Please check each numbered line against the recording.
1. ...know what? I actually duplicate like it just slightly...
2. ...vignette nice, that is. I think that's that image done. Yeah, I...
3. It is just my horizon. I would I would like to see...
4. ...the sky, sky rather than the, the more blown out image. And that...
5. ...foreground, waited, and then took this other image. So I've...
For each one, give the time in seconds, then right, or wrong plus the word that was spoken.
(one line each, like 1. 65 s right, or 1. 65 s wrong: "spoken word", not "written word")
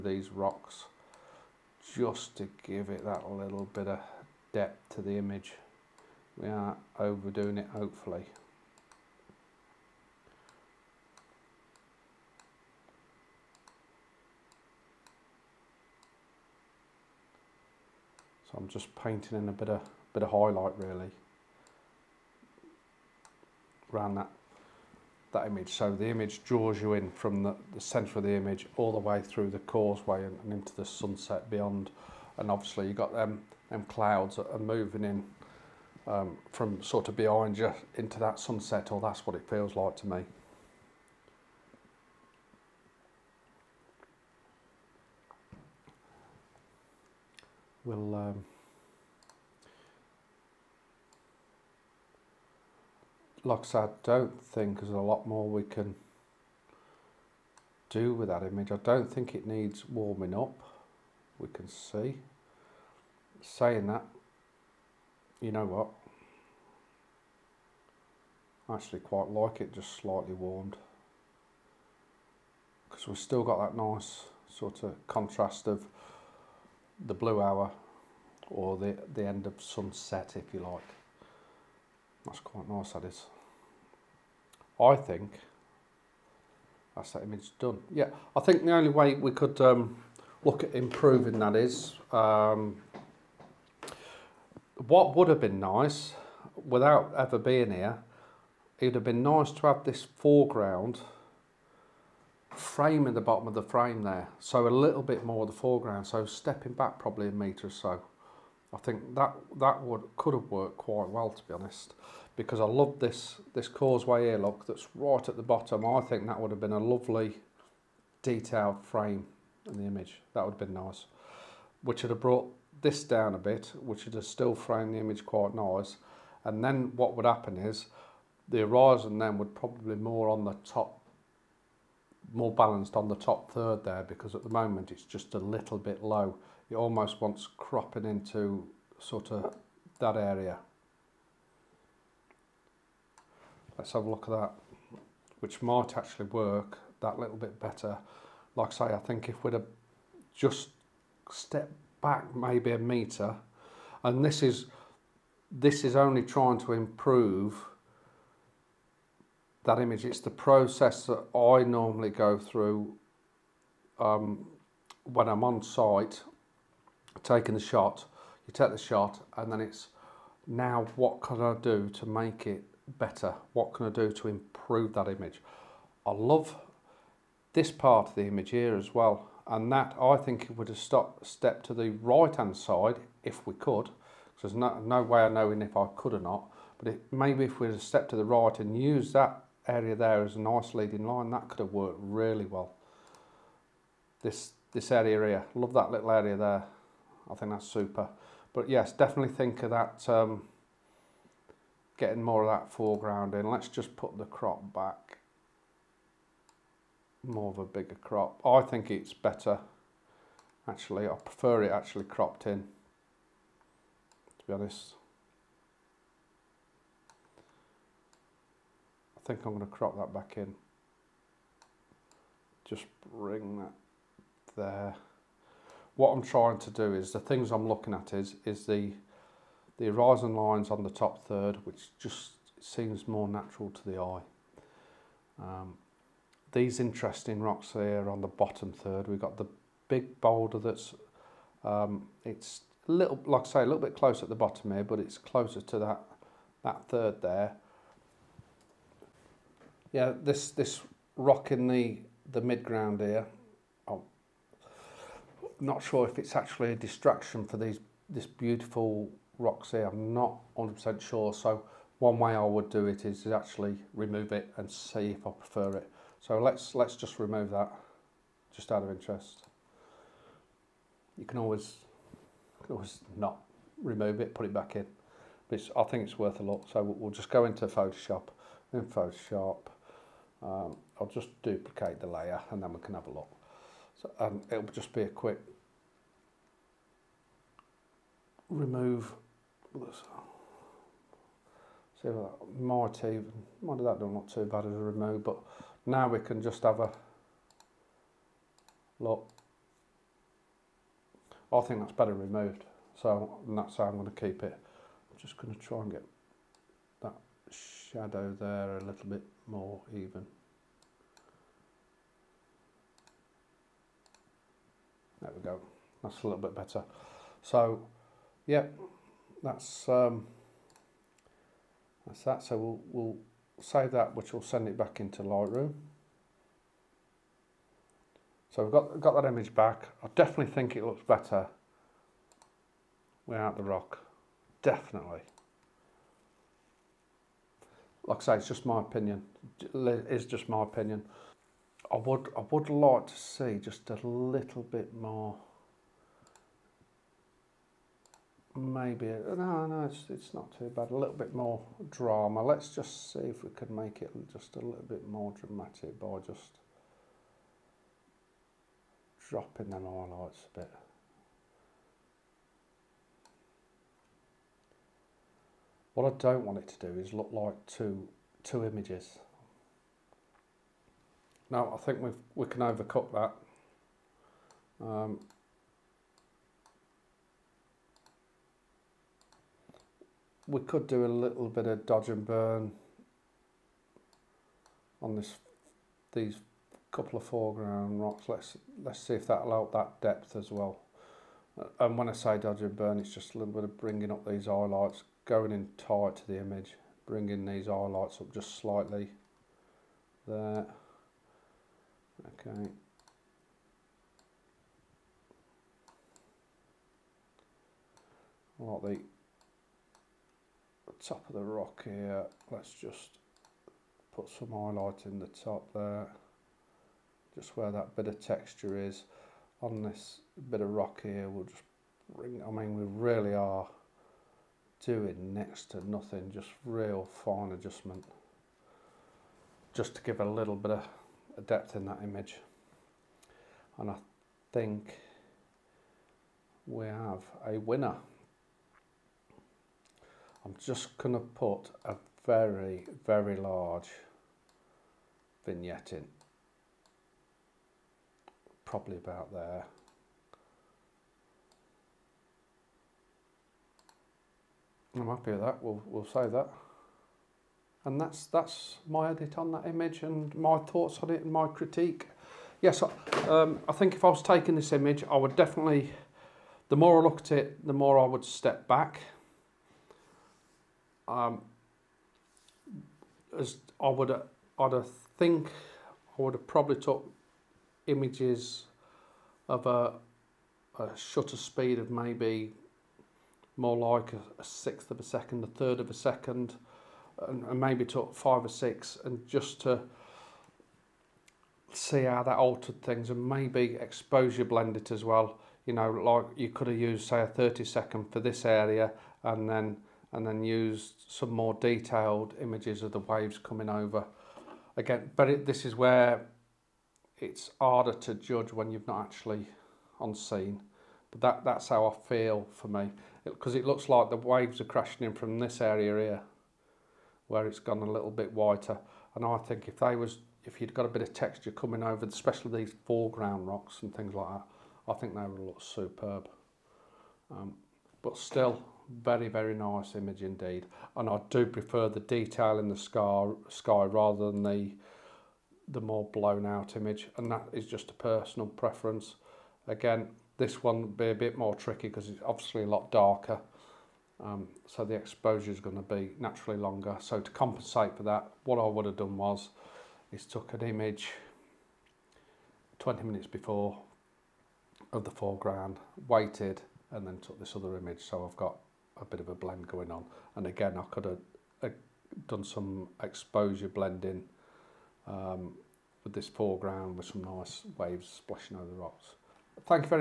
1. 65 s wrong: "quite", not "duplicate"
2. 82 s wrong: "quite", not "vignette"
3. 339 s wrong: "opinion", not "horizon"
4. 532 s right
5. 555 s right.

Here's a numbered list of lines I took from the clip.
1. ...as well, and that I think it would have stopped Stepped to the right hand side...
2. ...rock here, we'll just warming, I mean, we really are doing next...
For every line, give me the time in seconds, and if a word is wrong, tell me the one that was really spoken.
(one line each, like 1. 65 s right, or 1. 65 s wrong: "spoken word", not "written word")
1. 178 s right
2. 420 s wrong: "bring", not "warming".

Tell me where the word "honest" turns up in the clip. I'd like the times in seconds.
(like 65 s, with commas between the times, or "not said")
111 s, 214 s.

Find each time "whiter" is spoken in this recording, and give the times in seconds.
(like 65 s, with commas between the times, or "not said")
518 s.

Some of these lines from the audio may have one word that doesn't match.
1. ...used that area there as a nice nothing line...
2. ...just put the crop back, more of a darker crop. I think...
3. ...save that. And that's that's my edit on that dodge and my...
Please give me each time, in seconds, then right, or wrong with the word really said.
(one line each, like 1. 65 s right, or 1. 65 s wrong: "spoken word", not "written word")
1. 188 s wrong: "leading", not "nothing"
2. 203 s wrong: "bigger", not "darker"
3. 456 s wrong: "image", not "dodge".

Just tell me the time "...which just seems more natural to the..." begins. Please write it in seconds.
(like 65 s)
231 s.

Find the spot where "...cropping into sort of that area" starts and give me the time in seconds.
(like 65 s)
137 s.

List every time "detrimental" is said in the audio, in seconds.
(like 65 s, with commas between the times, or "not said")
not said.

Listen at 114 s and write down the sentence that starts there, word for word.
Look, that's right at the bottom.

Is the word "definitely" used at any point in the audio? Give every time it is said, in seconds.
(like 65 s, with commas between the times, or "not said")
198 s, 330 s, 334 s, 465 s.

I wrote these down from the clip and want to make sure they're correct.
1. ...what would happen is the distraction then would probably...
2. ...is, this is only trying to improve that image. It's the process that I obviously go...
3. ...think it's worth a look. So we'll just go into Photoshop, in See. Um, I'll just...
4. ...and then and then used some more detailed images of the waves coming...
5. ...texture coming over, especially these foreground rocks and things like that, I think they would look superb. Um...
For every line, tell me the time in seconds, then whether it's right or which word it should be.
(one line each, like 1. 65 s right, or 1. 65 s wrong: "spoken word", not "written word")
1. 126 s wrong: "horizon", not "distraction"
2. 154 s wrong: "normally", not "obviously"
3. 275 s wrong: "Photoshop", not "See"
4. 499 s right
5. 521 s right.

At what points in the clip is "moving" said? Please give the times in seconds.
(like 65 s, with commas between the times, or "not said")
34 s.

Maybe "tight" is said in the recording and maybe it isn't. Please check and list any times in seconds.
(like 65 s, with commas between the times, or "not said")
395 s.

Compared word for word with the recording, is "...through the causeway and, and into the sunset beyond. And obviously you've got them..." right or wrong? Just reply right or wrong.
right.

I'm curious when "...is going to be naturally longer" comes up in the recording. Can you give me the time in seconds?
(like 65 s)
545 s.